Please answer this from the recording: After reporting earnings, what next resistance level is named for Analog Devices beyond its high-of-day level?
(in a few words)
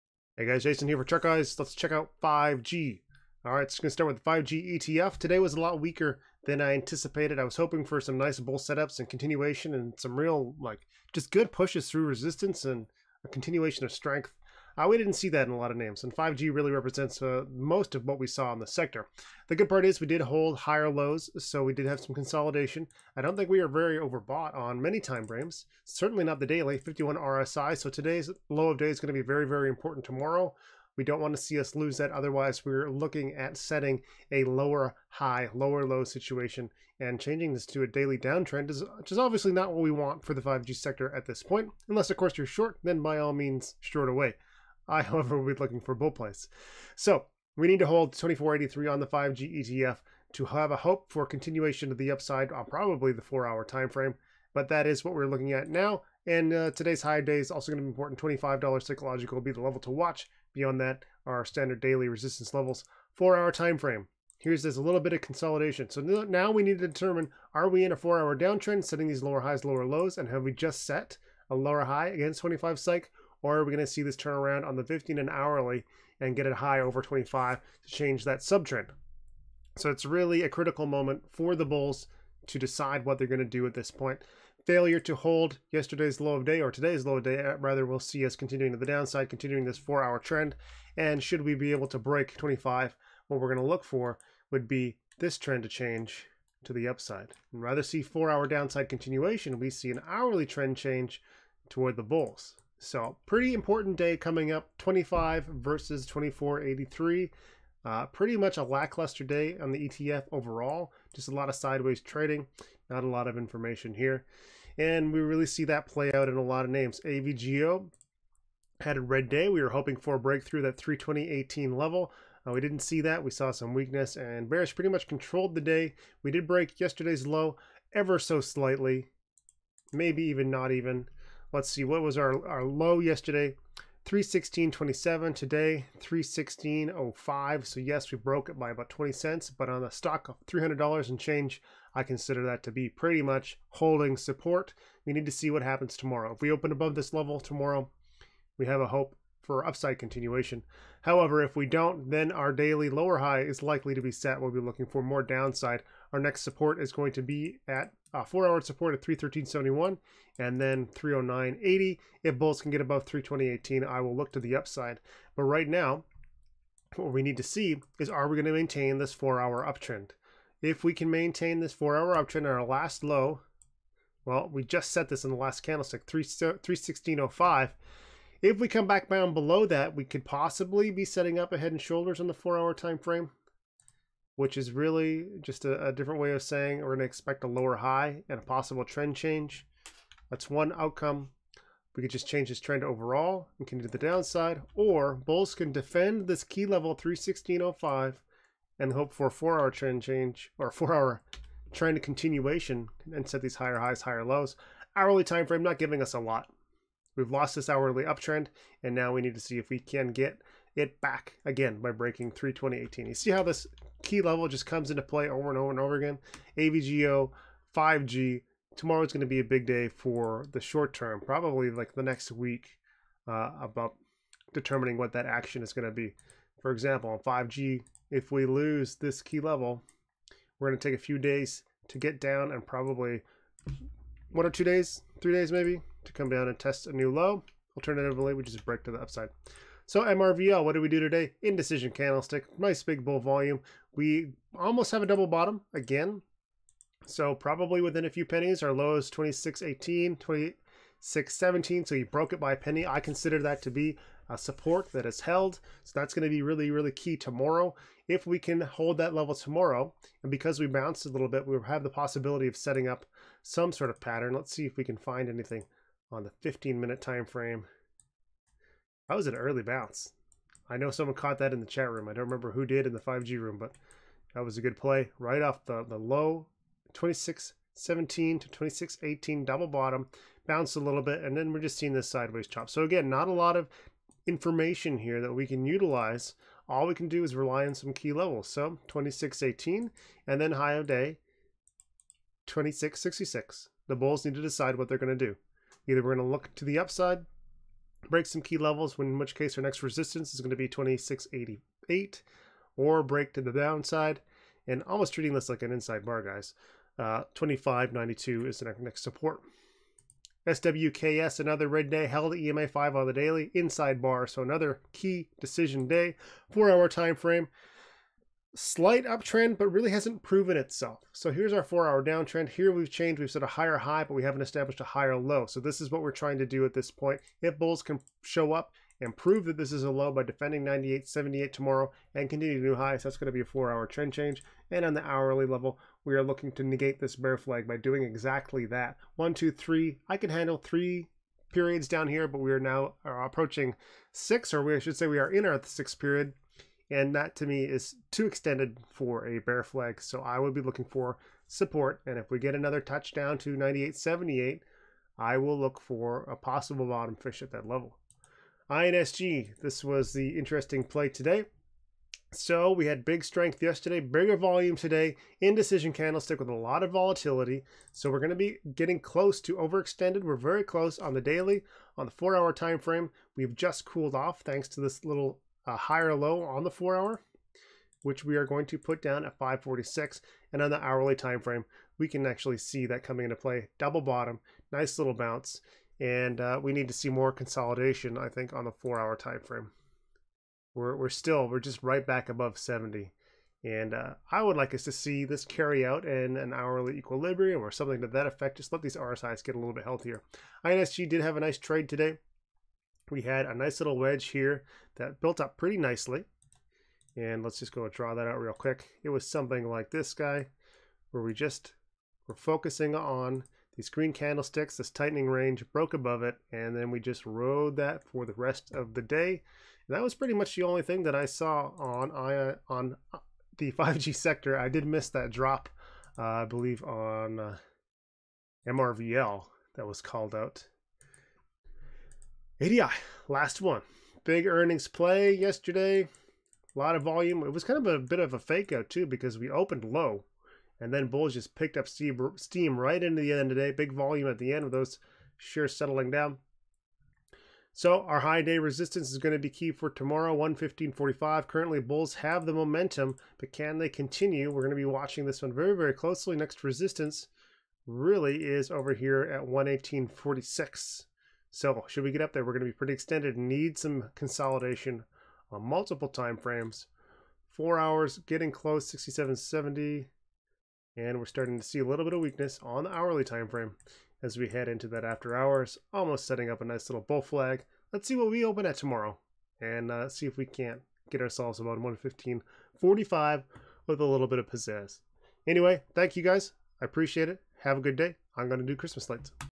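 118.46.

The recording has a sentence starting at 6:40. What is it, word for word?
INSG did have a nice trade today we had a nice little wedge here that built up pretty nicely.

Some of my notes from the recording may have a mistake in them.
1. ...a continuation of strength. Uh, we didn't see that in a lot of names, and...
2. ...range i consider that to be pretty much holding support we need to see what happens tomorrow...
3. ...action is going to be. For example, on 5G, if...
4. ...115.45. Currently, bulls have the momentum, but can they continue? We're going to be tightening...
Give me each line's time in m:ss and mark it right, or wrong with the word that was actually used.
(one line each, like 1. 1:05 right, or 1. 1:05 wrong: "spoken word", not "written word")
1. 0:13 right
2. 2:21 wrong: "change", not "range"
3. 3:45 right
4. 7:30 wrong: "watching", not "tightening".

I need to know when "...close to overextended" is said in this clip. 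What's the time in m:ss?
6:09.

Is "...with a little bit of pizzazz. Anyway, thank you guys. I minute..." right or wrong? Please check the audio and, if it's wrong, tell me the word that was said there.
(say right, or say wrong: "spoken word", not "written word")
wrong: "appreciate", not "minute".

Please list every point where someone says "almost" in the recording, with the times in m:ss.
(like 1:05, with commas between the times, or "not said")
4:04, 5:04, 7:55.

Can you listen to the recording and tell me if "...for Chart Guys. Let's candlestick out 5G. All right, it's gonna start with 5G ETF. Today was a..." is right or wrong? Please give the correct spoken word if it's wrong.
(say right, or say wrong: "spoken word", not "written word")
wrong: "check", not "candlestick".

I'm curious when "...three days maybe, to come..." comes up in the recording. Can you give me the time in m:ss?
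3:55.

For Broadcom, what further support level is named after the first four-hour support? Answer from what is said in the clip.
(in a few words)
309.80.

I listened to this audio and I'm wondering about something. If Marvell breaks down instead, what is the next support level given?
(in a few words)
25.92.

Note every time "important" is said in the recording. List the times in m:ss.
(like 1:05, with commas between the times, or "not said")
0:29, 0:57, 1:43.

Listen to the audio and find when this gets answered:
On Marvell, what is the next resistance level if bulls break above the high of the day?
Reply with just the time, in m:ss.
5:00.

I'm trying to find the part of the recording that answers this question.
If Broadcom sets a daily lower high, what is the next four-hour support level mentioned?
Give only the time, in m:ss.
2:39.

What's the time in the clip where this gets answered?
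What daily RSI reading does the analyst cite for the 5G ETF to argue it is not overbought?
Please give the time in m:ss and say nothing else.
0:26.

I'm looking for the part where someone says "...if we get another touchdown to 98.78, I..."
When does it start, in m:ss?
5:52.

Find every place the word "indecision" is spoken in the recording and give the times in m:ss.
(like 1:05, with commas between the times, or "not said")
4:01, 6:05.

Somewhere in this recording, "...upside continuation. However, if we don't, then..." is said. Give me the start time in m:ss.
2:29.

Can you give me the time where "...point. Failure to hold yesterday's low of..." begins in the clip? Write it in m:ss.
1:23.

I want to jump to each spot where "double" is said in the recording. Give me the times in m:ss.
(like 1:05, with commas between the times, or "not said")
4:05, 4:39, 6:23.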